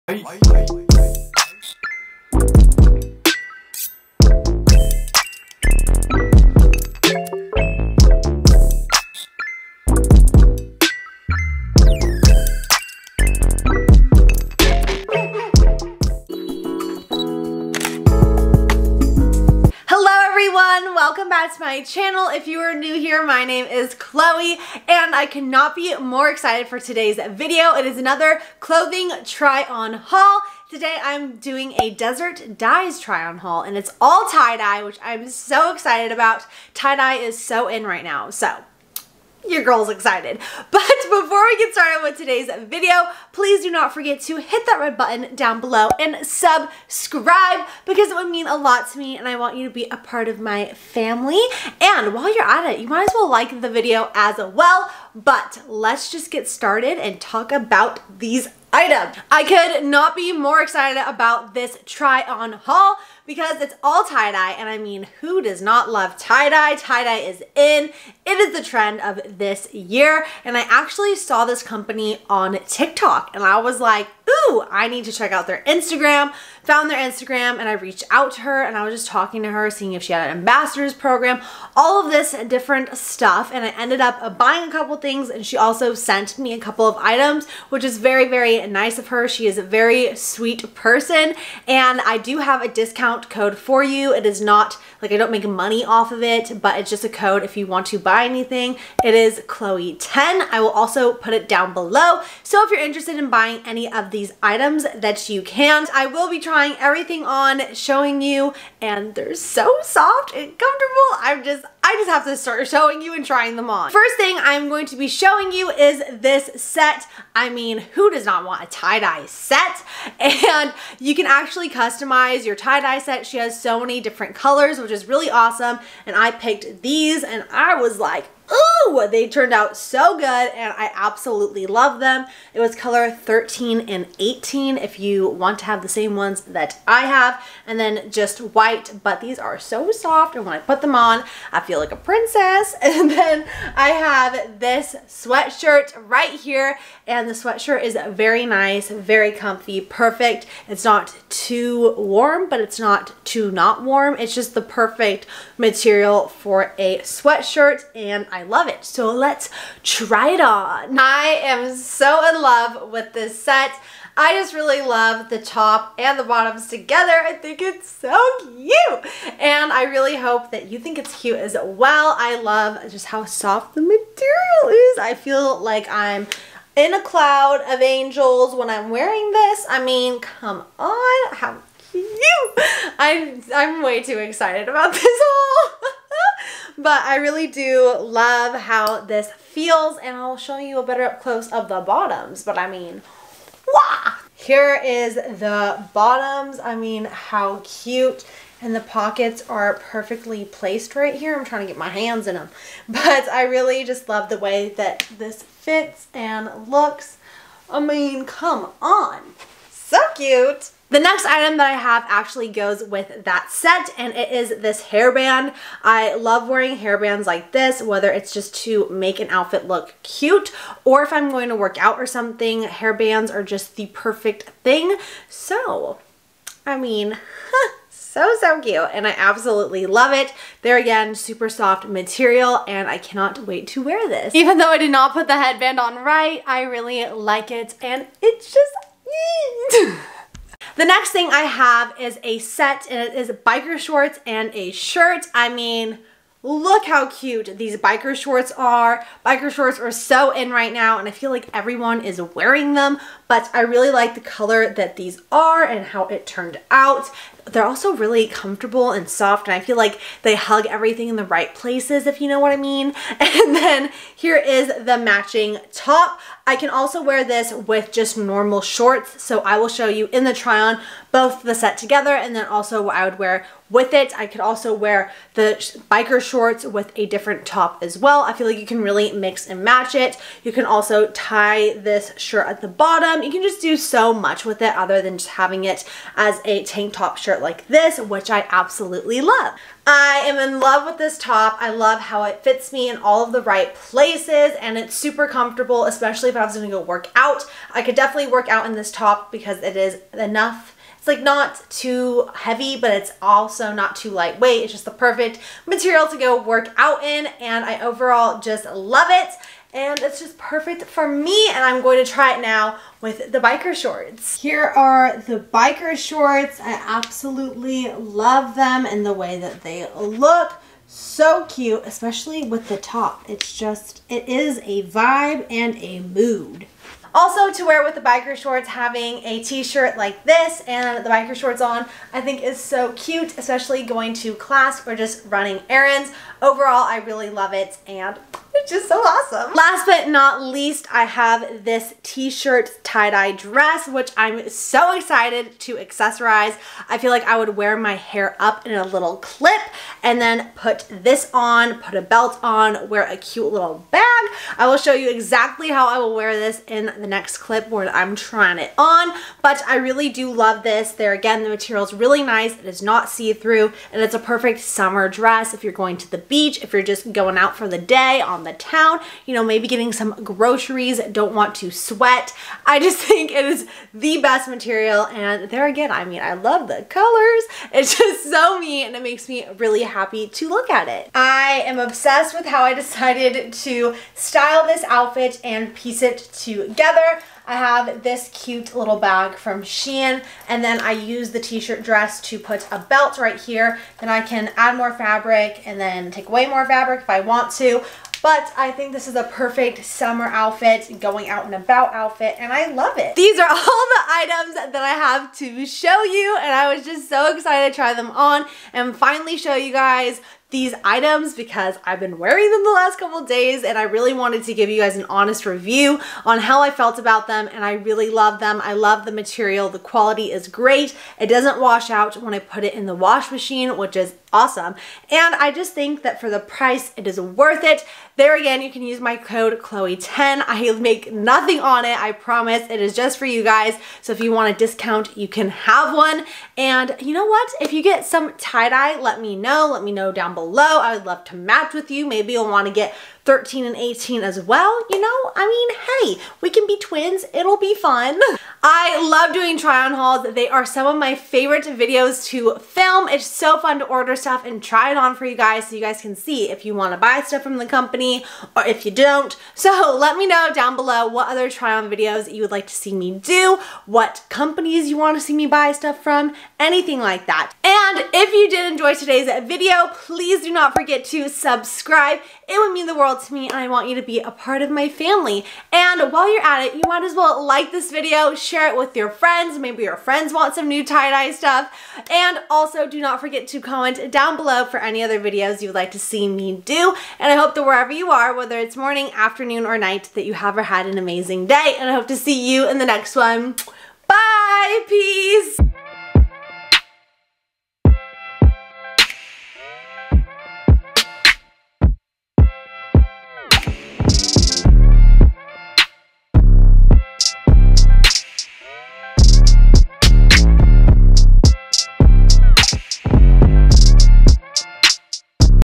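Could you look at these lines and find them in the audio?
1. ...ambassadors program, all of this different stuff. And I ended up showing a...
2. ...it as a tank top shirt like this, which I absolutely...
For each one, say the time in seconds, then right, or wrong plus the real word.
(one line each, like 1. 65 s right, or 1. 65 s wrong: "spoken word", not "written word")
1. 80 s wrong: "buying", not "showing"
2. 285 s right.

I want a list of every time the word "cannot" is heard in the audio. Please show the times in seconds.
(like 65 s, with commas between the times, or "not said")
25 s, 232 s.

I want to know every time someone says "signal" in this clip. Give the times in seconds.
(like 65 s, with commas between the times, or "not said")
not said.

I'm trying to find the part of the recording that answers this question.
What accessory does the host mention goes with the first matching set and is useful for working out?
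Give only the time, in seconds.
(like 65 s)
214 s.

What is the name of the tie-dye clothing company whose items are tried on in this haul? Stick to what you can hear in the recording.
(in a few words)
Desert Dyes.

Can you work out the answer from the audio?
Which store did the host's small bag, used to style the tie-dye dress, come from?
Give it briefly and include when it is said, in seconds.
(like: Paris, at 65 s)
Shein, at 389 s.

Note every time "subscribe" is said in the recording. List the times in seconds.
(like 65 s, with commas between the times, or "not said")
46 s, 471 s.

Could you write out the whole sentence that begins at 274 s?
I could also wear the biker shorts with a different top as well.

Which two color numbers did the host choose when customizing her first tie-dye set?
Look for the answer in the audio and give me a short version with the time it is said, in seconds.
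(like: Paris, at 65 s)
13 and 18, at 132 s.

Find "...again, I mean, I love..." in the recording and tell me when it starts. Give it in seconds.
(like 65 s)
375 s.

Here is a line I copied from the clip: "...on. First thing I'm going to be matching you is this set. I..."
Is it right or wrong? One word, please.
wrong.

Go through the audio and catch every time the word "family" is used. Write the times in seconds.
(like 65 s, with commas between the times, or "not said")
50 s, 474 s.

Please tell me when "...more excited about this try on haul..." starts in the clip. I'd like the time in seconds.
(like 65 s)
60 s.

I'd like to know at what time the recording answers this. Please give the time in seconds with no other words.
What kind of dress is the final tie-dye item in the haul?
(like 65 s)
342 s.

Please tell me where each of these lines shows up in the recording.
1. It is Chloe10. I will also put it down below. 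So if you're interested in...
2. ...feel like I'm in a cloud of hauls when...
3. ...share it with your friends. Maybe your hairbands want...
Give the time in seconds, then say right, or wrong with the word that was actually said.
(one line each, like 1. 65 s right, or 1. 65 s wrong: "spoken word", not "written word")
1. 99 s right
2. 175 s wrong: "angels", not "hauls"
3. 478 s wrong: "friends", not "hairbands".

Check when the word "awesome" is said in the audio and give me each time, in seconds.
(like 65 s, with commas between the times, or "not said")
125 s, 338 s, 424 s.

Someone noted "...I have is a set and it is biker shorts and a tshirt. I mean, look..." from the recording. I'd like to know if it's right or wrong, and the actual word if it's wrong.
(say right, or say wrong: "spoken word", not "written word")
wrong: "shirt", not "tshirt".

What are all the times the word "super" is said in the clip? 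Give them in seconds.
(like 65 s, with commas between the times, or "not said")
231 s, 294 s.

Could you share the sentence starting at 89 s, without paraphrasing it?
She is a very sweet person and I do have a discount code for you.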